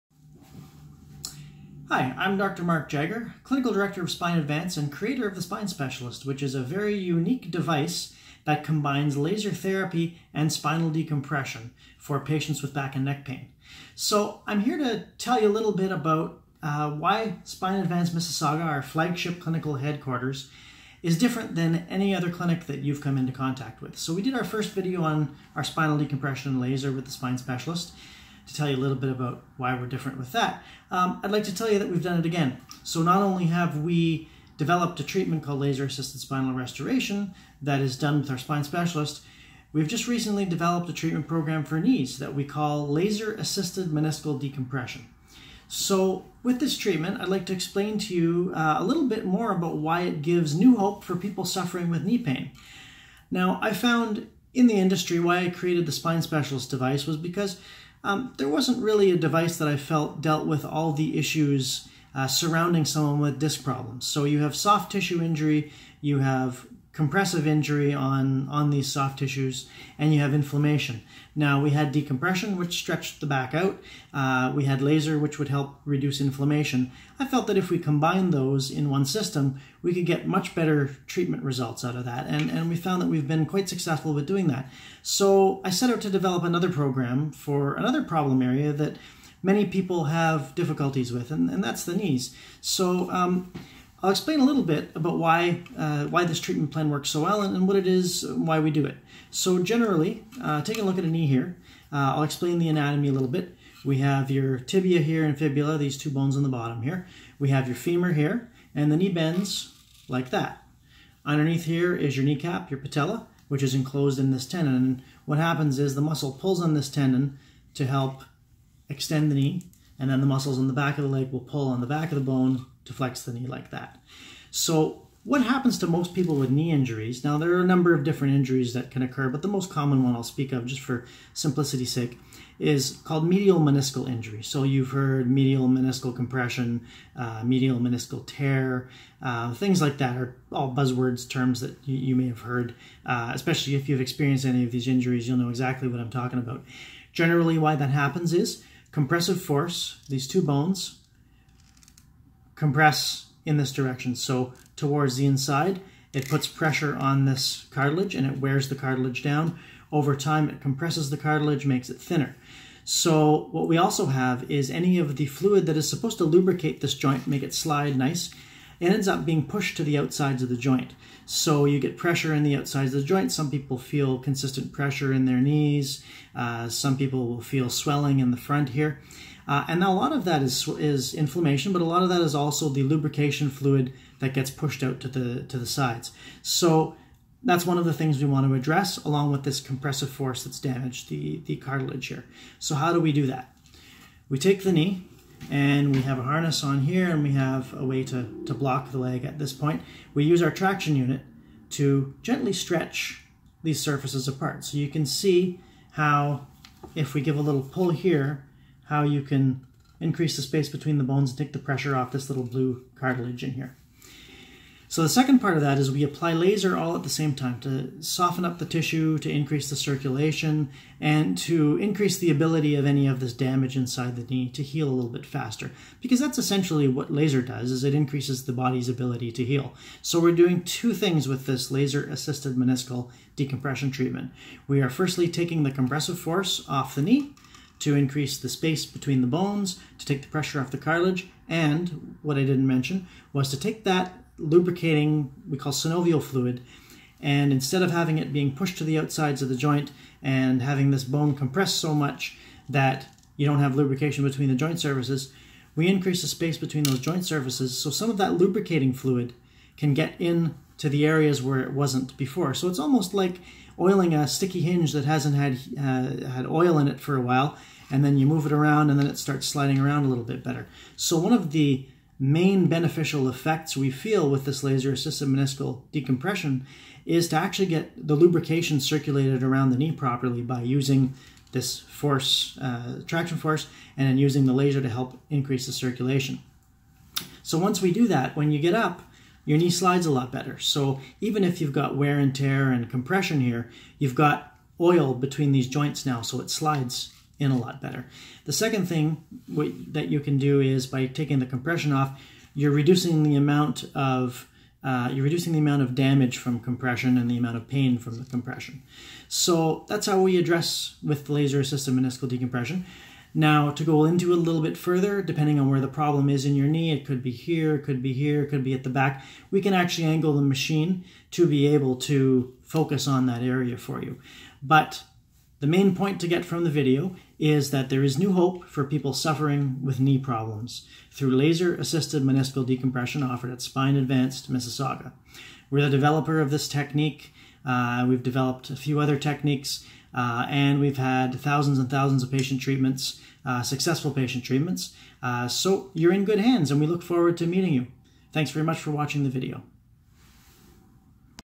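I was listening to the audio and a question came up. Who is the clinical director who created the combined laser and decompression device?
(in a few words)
Mark Jagger.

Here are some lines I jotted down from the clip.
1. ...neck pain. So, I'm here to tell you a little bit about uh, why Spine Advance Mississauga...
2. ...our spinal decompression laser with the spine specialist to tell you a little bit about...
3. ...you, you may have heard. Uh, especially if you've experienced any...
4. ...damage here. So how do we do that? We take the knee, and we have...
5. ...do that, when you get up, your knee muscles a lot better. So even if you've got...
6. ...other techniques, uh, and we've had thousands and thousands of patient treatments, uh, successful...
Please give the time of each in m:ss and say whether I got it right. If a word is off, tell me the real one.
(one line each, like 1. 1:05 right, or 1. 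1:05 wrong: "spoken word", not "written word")
1. 0:13 right
2. 0:25 right
3. 2:21 right
4. 3:11 wrong: "cartilage", not "damage"
5. 4:47 wrong: "slides", not "muscles"
6. 5:38 right.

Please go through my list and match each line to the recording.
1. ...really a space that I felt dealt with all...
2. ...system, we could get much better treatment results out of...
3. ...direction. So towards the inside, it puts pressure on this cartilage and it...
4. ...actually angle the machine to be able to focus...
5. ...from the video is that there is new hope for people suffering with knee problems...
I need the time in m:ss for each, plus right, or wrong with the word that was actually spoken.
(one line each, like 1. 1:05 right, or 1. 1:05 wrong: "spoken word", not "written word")
1. 0:58 wrong: "device", not "space"
2. 1:19 right
3. 2:33 right
4. 5:19 right
5. 5:26 right.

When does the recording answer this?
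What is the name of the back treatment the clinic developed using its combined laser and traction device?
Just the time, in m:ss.
0:35.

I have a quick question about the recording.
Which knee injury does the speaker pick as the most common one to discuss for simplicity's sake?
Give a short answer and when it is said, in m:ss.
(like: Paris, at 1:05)
medial meniscal injury, at 2:13.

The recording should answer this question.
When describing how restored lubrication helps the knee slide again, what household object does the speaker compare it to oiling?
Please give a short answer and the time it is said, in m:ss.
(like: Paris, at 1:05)
a sticky hinge, at 4:24.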